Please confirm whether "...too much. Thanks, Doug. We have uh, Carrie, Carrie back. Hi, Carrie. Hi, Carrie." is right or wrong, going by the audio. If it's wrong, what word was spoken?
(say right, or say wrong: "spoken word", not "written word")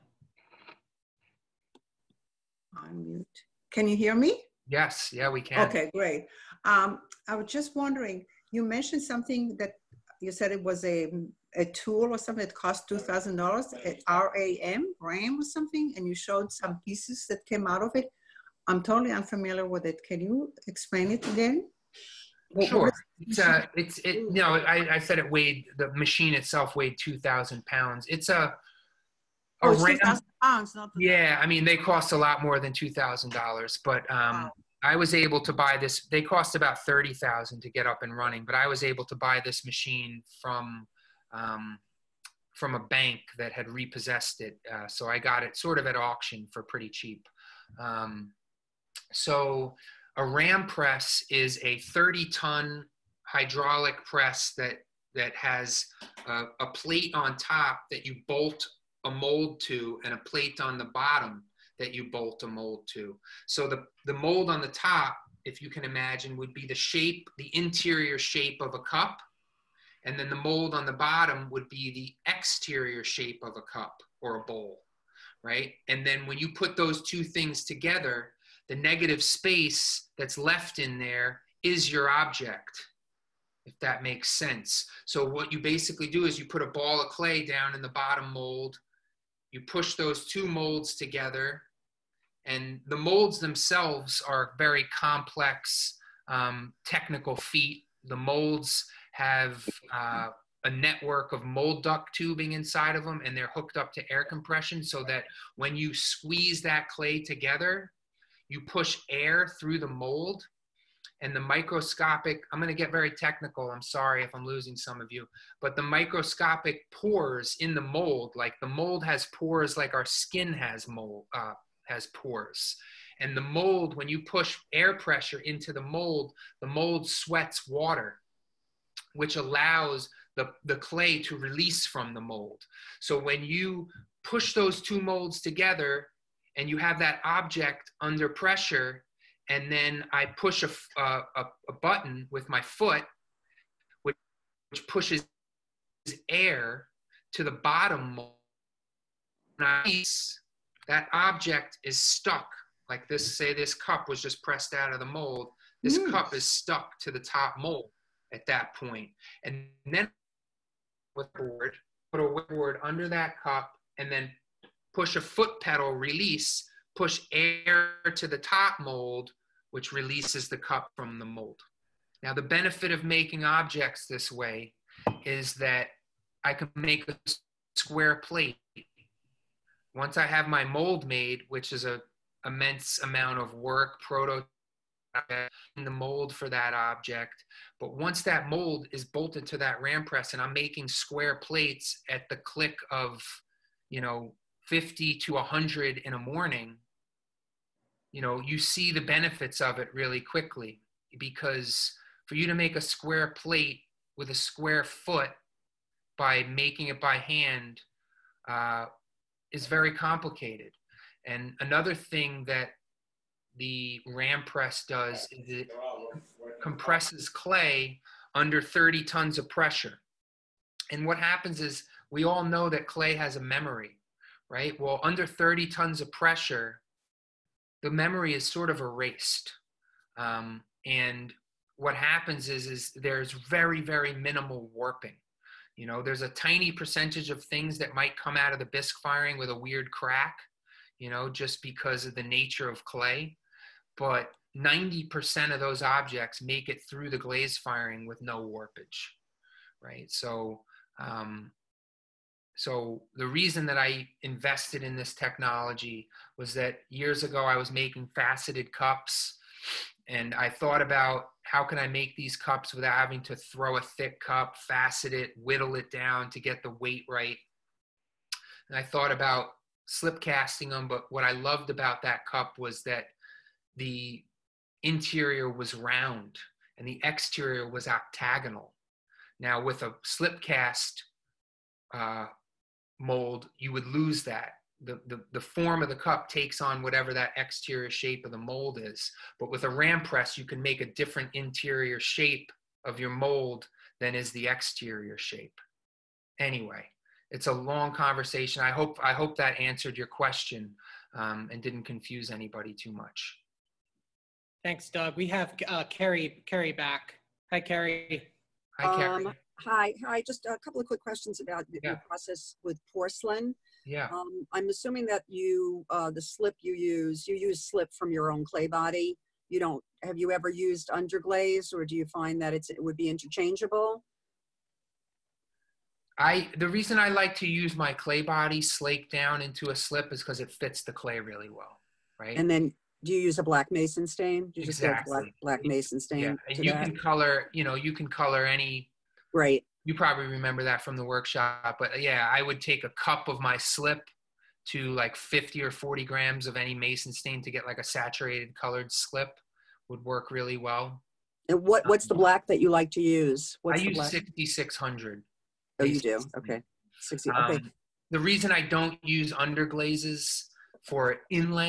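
right.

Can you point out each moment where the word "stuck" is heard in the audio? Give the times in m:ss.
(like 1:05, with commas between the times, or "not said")
2:31, 2:36.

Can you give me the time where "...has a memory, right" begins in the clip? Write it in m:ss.
3:43.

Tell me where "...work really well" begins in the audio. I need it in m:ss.
5:50.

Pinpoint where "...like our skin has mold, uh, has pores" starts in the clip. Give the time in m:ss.
1:59.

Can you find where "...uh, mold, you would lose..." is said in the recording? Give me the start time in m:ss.
4:41.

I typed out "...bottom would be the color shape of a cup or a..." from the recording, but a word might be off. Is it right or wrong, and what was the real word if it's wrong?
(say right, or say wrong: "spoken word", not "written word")
wrong: "exterior", not "color".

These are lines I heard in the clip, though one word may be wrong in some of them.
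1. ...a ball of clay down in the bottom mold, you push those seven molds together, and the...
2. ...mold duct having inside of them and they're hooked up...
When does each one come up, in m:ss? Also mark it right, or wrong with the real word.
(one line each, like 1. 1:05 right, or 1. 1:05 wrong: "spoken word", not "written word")
1. 1:26 wrong: "two", not "seven"
2. 1:41 wrong: "tubing", not "having".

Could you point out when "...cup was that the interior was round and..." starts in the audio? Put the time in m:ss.
4:32.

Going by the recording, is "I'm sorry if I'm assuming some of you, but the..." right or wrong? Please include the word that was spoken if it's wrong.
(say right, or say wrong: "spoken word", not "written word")
wrong: "losing", not "assuming".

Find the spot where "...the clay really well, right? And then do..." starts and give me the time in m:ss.
5:30.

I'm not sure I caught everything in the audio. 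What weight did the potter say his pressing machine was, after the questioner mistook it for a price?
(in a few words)
2,000 pounds.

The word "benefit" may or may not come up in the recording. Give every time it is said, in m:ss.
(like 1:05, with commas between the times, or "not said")
2:52, 3:19.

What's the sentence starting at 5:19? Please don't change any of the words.
You don't, have you ever used underglaze or do you find that it's, it would be interchangeable?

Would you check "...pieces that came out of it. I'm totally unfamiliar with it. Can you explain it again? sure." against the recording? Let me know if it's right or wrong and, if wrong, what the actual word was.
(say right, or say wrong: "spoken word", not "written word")
right.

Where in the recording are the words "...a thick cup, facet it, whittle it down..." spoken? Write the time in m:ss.
4:23.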